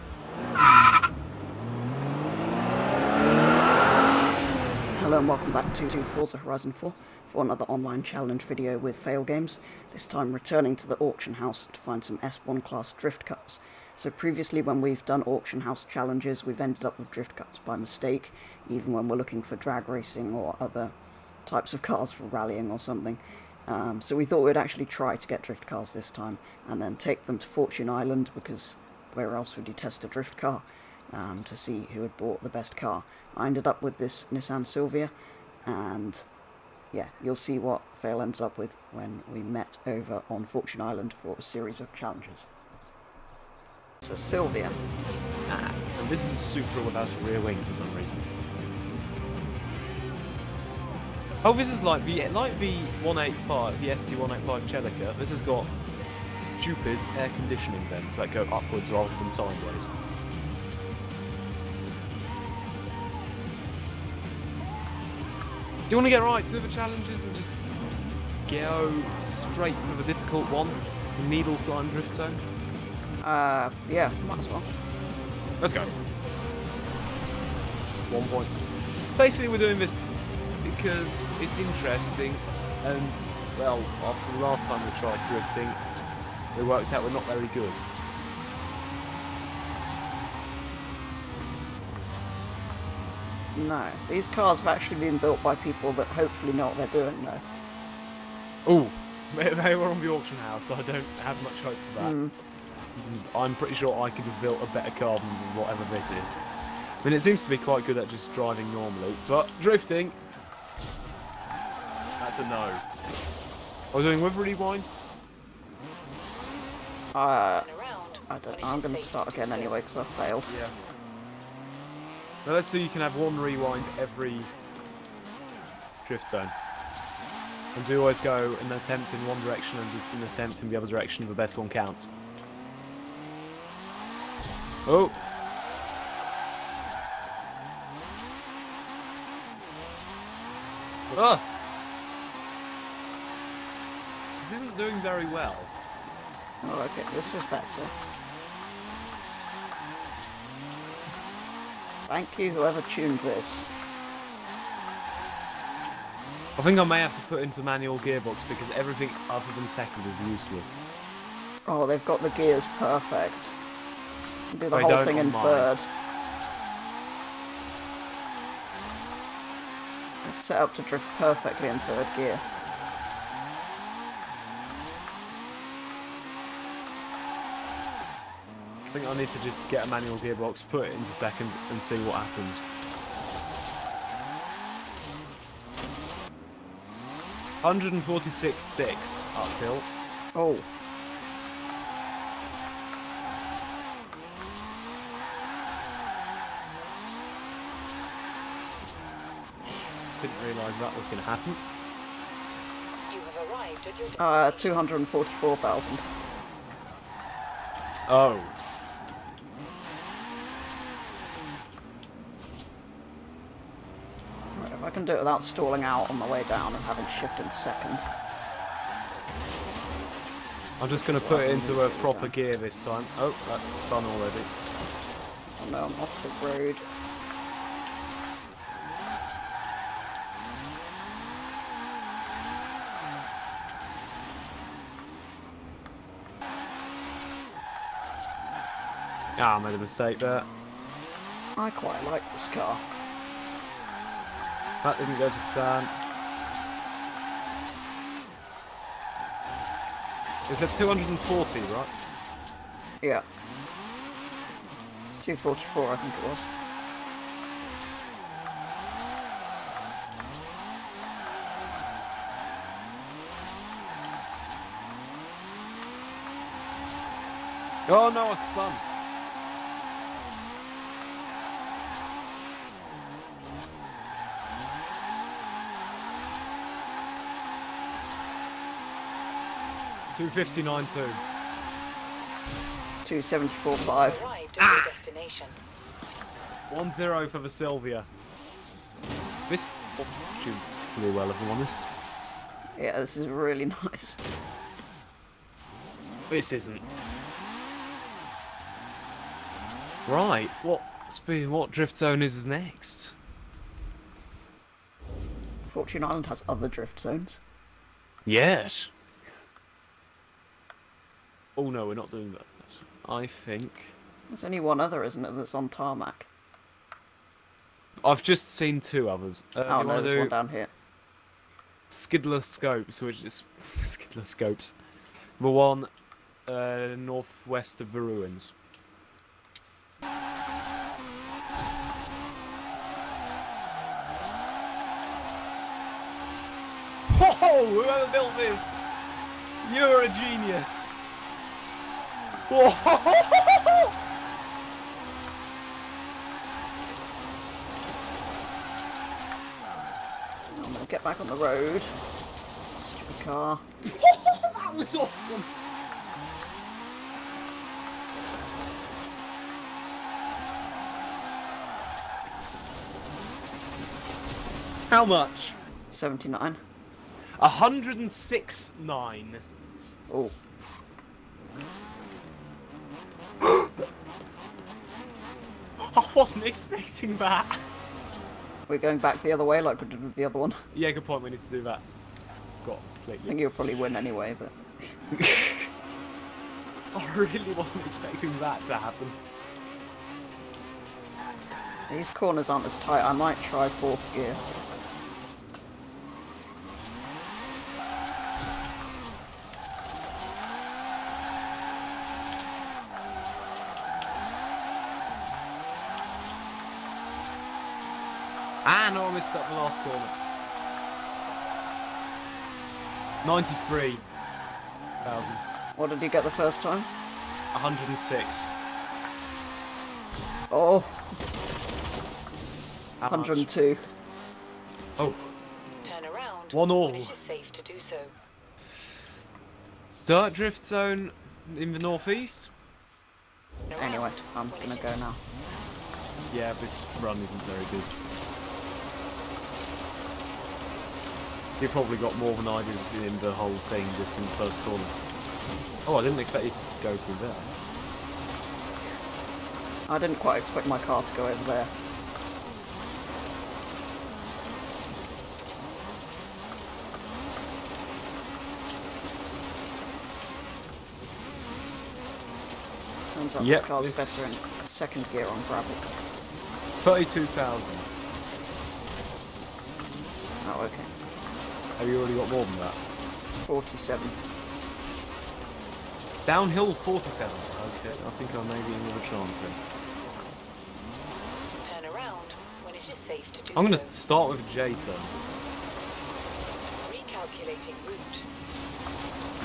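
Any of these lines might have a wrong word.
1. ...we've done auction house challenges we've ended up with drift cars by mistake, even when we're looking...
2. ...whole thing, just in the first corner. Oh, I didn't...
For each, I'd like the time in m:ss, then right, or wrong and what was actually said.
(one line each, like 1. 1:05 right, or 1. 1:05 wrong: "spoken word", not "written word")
1. 0:14 right
2. 7:23 right.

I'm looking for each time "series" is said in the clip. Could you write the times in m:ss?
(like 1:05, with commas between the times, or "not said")
0:41.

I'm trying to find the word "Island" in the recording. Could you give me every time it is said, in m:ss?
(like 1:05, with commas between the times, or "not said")
0:27, 0:40, 5:06.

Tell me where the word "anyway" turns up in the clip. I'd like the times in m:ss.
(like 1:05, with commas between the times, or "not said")
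1:59, 6:23, 7:13.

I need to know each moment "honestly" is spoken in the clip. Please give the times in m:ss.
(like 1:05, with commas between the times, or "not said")
not said.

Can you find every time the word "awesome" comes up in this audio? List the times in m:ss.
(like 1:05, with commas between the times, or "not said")
5:54.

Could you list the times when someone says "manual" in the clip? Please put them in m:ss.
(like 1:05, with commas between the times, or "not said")
2:37, 2:59.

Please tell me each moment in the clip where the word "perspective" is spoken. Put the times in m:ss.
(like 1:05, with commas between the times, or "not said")
not said.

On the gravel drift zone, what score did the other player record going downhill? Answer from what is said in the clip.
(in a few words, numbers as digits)
47.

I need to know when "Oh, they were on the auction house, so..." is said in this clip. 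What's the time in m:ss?
1:38.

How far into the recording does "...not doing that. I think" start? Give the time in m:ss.
5:11.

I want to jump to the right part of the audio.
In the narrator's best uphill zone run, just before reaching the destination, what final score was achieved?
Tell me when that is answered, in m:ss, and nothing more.
4:43.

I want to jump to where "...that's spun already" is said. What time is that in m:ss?
3:43.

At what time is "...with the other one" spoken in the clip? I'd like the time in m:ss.
6:20.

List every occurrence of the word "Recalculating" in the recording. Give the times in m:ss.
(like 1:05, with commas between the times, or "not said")
8:06.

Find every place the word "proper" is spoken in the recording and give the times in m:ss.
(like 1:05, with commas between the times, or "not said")
3:41.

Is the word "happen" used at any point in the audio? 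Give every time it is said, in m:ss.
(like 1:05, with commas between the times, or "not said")
3:02, 3:21, 6:28.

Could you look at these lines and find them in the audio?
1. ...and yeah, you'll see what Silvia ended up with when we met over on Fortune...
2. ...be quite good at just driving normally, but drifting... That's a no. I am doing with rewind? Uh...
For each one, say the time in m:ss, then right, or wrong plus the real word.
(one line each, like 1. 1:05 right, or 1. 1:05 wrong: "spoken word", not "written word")
1. 0:35 wrong: "Fail", not "Silvia"
2. 1:47 right.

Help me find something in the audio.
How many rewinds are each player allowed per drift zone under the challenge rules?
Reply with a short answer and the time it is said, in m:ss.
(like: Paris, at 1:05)
1, at 2:03.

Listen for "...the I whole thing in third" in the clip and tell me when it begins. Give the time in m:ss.
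2:44.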